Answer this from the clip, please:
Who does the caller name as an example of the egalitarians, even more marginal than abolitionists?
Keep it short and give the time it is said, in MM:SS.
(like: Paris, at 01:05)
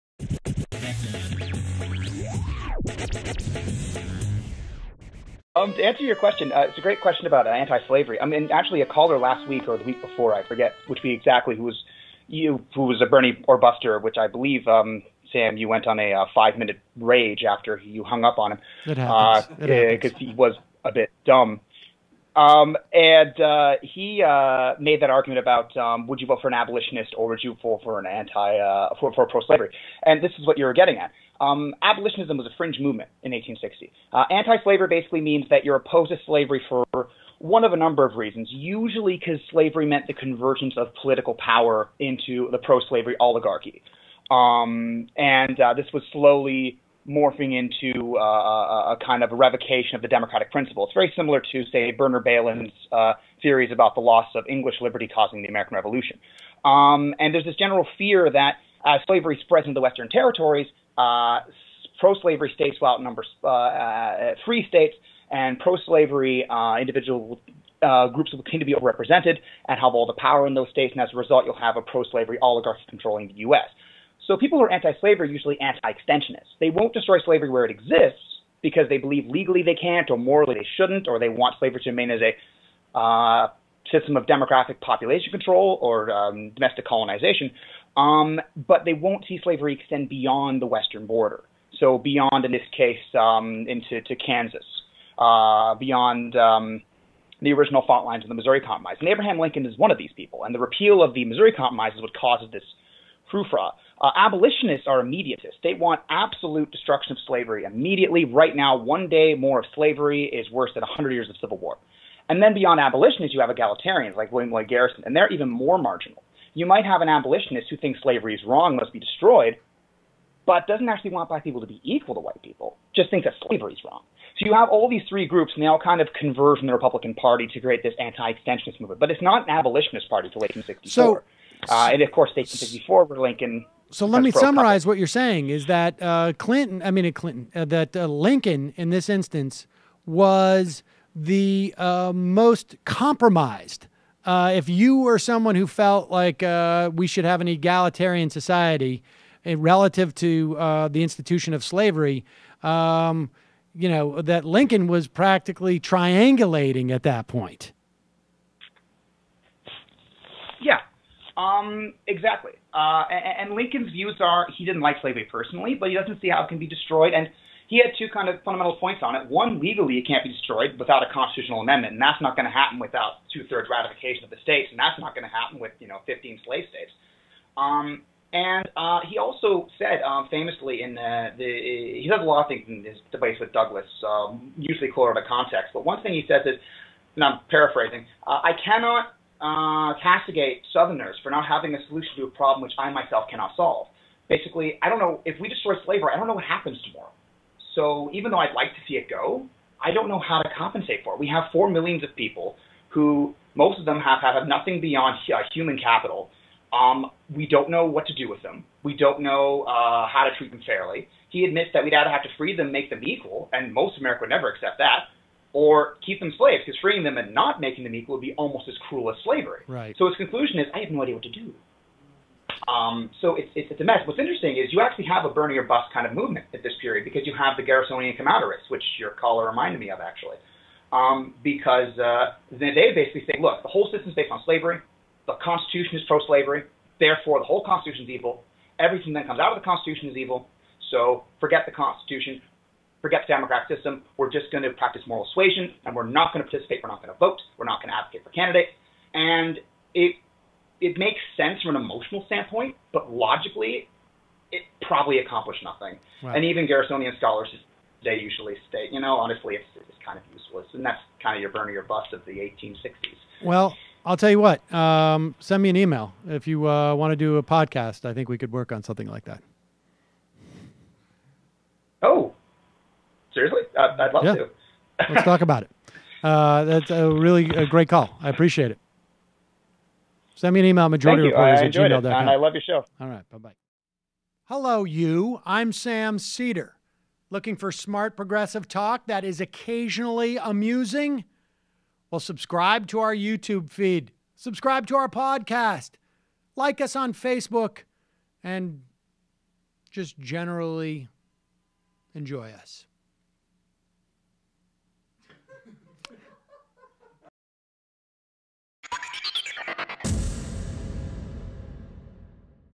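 William Lloyd Garrison, at 01:54.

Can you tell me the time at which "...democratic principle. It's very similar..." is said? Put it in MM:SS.
00:50.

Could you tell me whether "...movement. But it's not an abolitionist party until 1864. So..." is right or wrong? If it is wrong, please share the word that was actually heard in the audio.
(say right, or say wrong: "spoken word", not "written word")
right.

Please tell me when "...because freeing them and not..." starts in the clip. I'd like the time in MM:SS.
03:36.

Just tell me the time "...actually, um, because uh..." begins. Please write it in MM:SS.
03:49.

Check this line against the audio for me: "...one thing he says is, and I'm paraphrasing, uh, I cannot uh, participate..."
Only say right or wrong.
wrong.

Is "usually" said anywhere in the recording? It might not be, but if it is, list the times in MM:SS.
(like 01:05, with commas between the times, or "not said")
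00:38, 01:15, 03:04, 04:18.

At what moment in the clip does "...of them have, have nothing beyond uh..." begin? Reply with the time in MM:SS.
03:23.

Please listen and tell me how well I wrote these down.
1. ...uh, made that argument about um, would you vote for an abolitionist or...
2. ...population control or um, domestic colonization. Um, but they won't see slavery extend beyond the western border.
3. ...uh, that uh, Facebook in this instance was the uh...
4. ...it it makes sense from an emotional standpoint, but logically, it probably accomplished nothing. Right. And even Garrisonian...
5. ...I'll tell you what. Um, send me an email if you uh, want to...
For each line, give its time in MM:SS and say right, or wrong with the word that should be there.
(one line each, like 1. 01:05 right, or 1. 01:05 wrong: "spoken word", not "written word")
1. 00:24 right
2. 01:24 right
3. 02:17 wrong: "Lincoln", not "Facebook"
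4. 04:09 right
5. 04:24 right.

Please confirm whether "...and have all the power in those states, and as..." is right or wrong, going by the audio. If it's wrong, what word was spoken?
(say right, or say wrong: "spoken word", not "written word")
right.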